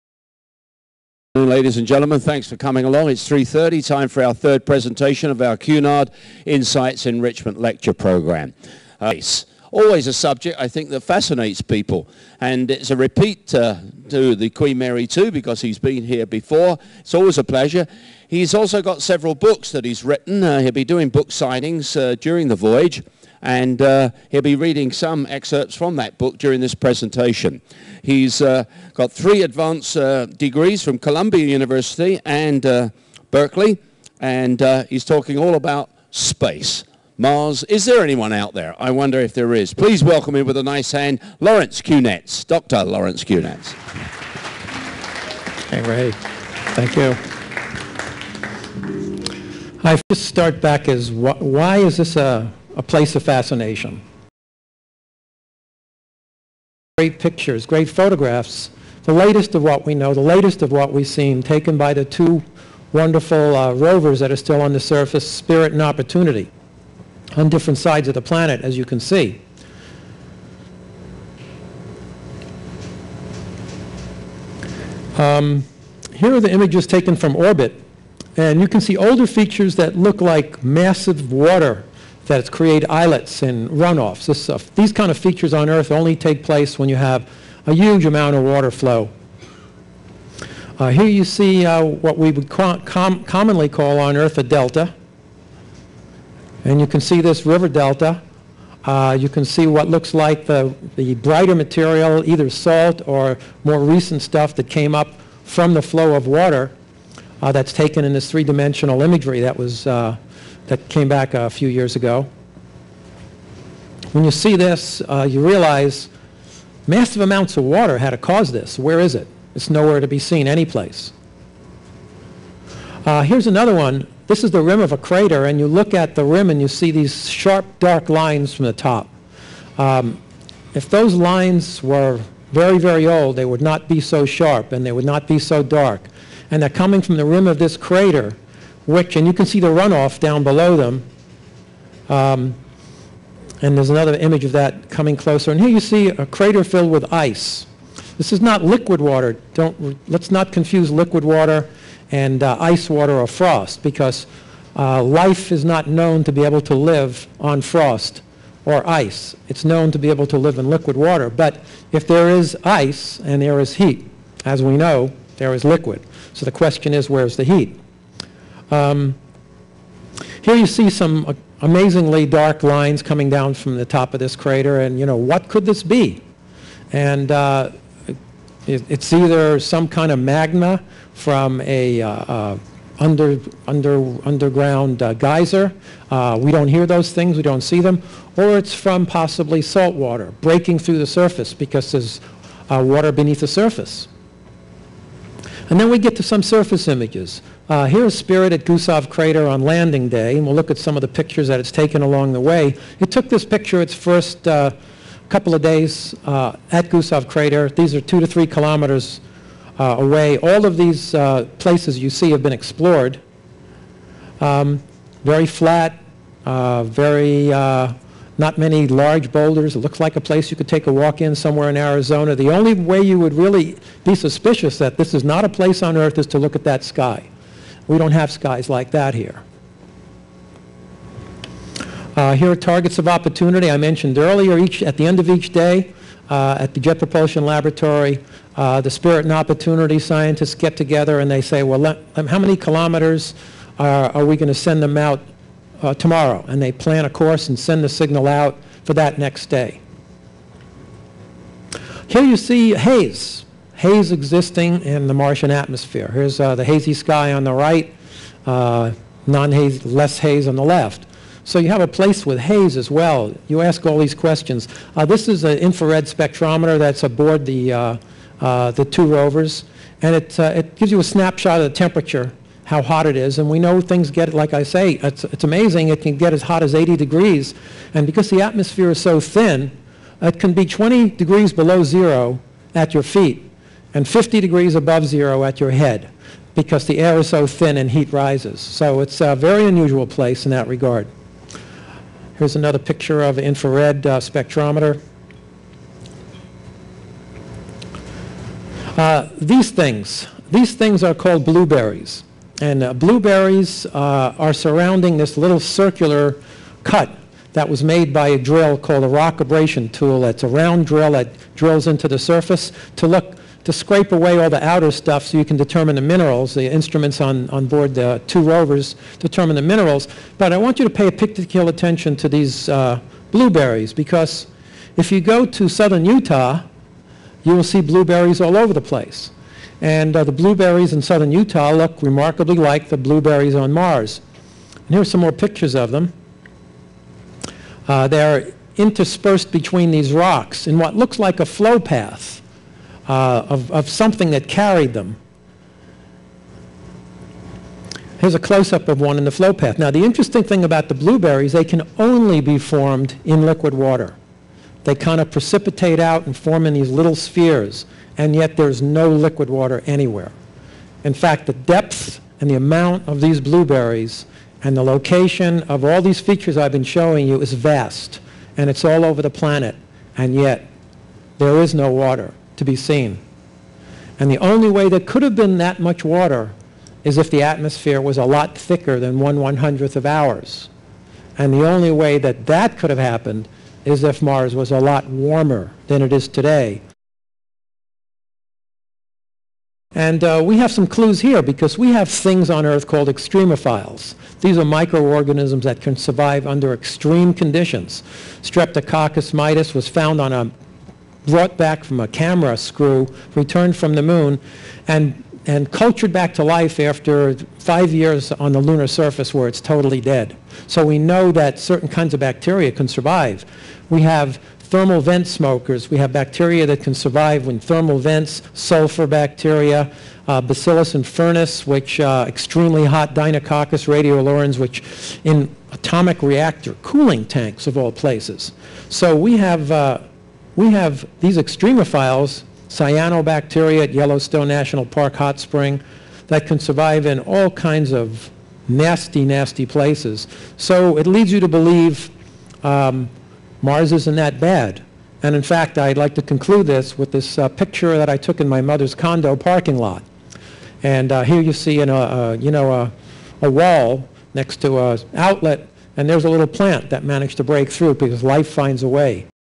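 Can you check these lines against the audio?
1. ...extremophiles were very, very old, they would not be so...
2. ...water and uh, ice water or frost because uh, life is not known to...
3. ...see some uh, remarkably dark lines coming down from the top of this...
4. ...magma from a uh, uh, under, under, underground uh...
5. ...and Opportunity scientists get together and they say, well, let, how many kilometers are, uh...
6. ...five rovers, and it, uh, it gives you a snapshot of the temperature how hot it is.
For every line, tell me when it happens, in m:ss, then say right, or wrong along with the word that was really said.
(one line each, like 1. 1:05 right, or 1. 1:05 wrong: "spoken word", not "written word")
1. 2:11 wrong: "lines", not "extremophiles"
2. 2:31 right
3. 2:50 wrong: "amazingly", not "remarkably"
4. 3:00 right
5. 3:59 right
6. 4:28 wrong: "two", not "five".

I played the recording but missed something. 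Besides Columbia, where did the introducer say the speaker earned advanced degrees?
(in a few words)
Berkeley.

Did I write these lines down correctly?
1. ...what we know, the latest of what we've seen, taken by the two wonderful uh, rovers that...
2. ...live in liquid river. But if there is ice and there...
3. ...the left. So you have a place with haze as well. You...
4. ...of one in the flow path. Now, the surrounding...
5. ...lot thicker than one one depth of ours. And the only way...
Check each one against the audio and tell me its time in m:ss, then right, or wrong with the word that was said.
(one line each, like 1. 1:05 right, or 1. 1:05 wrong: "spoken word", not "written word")
1. 0:59 right
2. 2:40 wrong: "water", not "river"
3. 4:20 right
4. 5:48 wrong: "interesting", not "surrounding"
5. 6:18 wrong: "hundredth", not "depth".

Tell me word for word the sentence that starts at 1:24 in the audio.
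This, these kind of features on Earth only take place when you have a huge amount of water flow.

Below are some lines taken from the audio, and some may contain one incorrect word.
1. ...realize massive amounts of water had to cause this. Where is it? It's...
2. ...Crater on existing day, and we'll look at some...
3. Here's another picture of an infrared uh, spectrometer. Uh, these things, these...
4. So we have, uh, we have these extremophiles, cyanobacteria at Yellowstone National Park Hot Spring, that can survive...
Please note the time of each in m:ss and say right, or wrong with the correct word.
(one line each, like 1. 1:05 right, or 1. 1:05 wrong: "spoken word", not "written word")
1. 1:55 right
2. 3:19 wrong: "landing", not "existing"
3. 4:52 right
4. 7:08 right.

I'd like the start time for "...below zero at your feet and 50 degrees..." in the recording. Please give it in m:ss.
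4:41.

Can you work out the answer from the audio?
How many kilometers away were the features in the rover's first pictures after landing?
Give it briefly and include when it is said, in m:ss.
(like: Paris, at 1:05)
2 to 3 kilometers, at 3:28.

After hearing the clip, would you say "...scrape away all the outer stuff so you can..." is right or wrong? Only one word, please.
right.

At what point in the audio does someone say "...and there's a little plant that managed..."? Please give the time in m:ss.
7:35.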